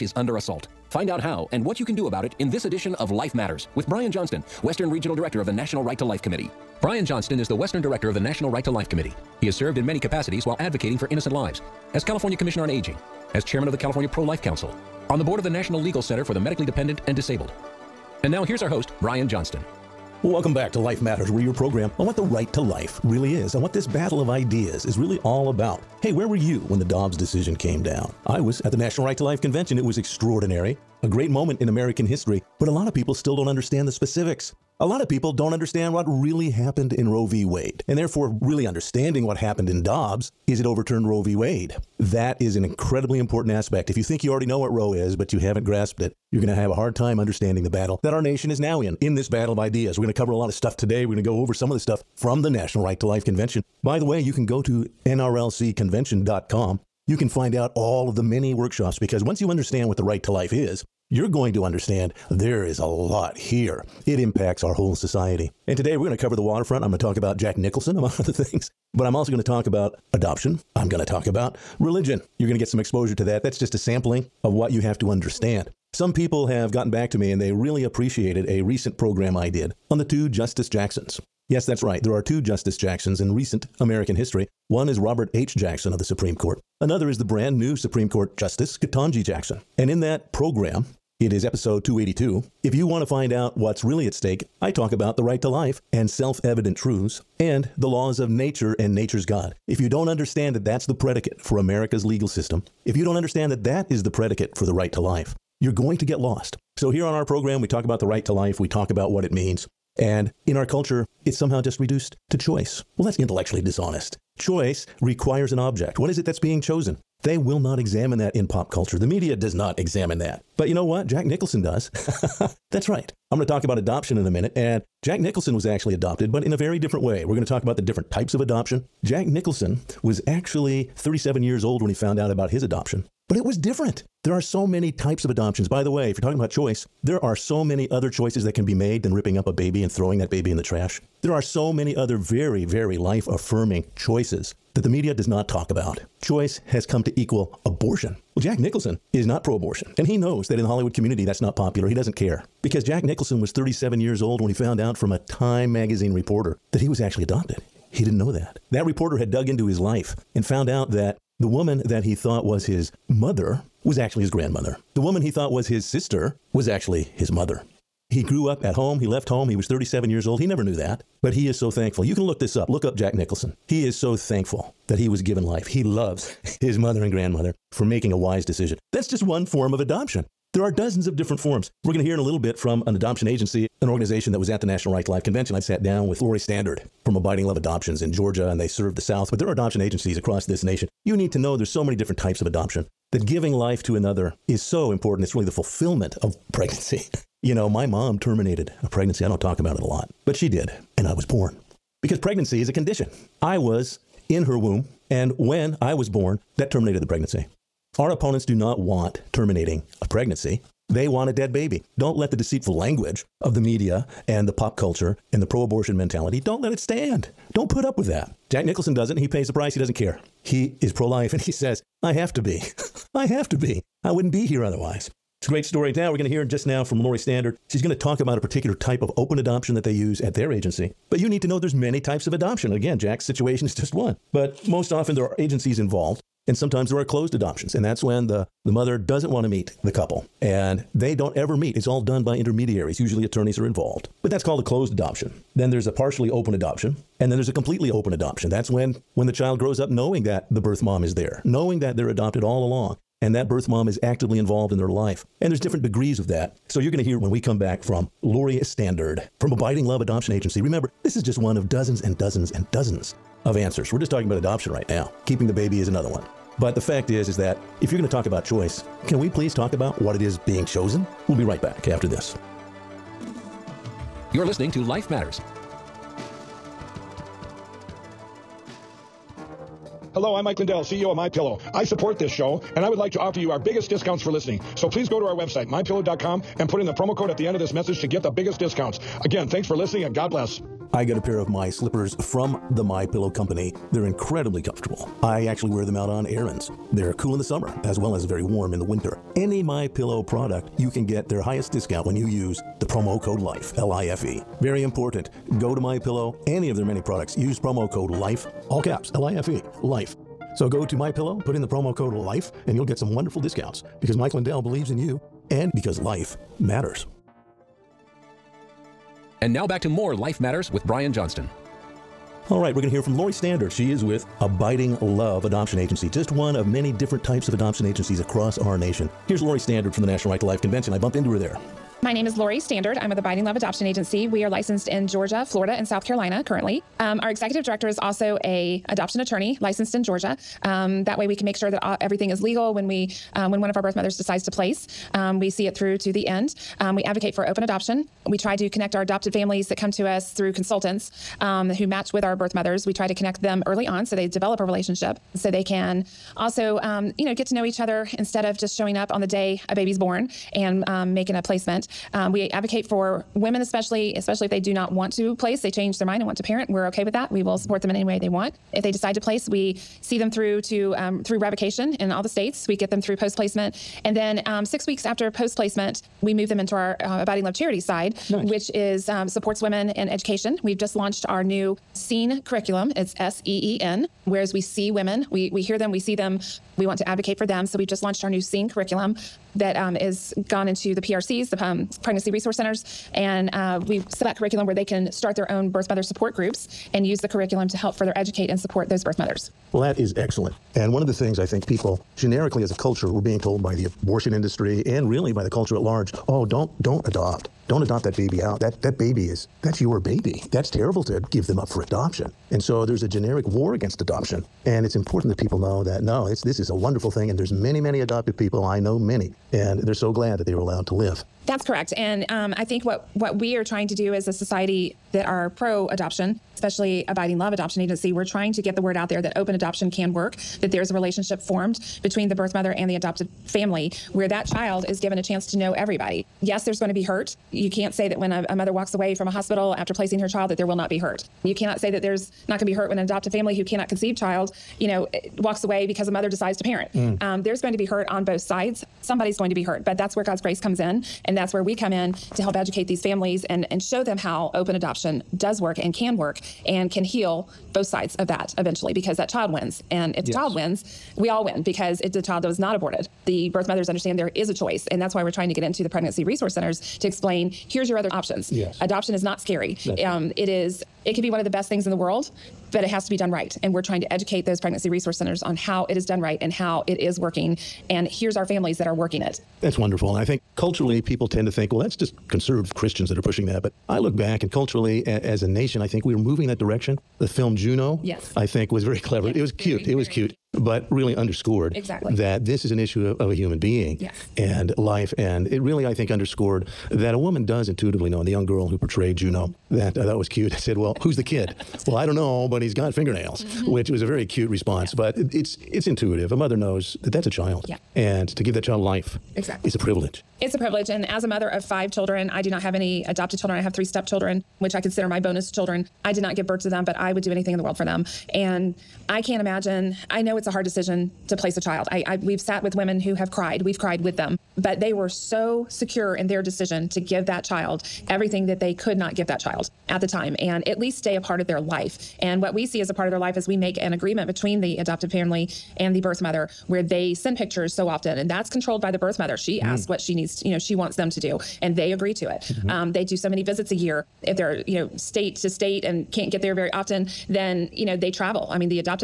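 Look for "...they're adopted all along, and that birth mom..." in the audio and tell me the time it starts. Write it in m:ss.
4:11.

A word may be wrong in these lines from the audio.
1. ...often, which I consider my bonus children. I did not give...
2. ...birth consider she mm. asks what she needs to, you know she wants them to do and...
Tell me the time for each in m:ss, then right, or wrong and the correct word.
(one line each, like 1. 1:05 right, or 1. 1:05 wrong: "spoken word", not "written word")
1. 8:33 wrong: "stepchildren", not "often"
2. 8:58 wrong: "mother", not "consider".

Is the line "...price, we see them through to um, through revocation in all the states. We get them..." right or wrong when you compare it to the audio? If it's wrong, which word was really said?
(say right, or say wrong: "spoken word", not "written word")
wrong: "place", not "price".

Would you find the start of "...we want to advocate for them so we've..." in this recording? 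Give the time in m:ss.
6:26.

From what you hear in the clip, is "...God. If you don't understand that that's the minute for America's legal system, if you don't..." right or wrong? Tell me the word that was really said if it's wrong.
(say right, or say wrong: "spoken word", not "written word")
wrong: "predicate", not "minute".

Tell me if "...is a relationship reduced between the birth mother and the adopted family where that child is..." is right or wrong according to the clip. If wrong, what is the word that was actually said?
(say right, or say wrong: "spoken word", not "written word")
wrong: "formed", not "reduced".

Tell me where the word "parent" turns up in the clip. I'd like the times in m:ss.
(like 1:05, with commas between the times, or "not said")
6:06, 7:26.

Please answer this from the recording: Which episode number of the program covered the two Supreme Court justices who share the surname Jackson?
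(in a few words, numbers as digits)
282.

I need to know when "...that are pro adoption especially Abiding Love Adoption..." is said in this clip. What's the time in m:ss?
7:05.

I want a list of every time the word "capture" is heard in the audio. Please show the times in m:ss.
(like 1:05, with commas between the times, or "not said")
not said.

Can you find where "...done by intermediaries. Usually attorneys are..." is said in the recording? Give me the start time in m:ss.
4:02.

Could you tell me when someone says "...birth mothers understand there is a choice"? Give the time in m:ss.
7:43.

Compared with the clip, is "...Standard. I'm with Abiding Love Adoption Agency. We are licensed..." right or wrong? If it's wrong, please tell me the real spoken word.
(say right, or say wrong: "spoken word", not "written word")
right.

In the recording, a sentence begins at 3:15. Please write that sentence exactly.
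It's really the fulfillment of pregnancy.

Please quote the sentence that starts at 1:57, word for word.
They will not examine that in pop culture.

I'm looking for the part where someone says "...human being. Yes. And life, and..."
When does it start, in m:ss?
8:13.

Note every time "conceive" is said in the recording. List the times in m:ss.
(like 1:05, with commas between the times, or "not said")
7:23.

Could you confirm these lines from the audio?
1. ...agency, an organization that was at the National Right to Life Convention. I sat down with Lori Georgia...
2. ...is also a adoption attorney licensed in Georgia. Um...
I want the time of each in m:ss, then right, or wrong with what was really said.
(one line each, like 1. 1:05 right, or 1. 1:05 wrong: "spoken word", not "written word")
1. 3:03 wrong: "Standard", not "Georgia"
2. 5:37 right.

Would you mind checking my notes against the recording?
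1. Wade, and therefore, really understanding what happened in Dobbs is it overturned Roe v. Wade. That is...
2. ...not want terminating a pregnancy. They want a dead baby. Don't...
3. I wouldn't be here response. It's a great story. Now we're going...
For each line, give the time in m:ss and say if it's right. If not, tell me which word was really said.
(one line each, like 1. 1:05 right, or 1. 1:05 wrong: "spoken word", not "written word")
1. 0:37 right
2. 3:28 right
3. 3:44 wrong: "otherwise", not "response".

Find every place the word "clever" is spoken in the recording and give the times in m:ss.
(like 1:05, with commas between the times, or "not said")
8:09.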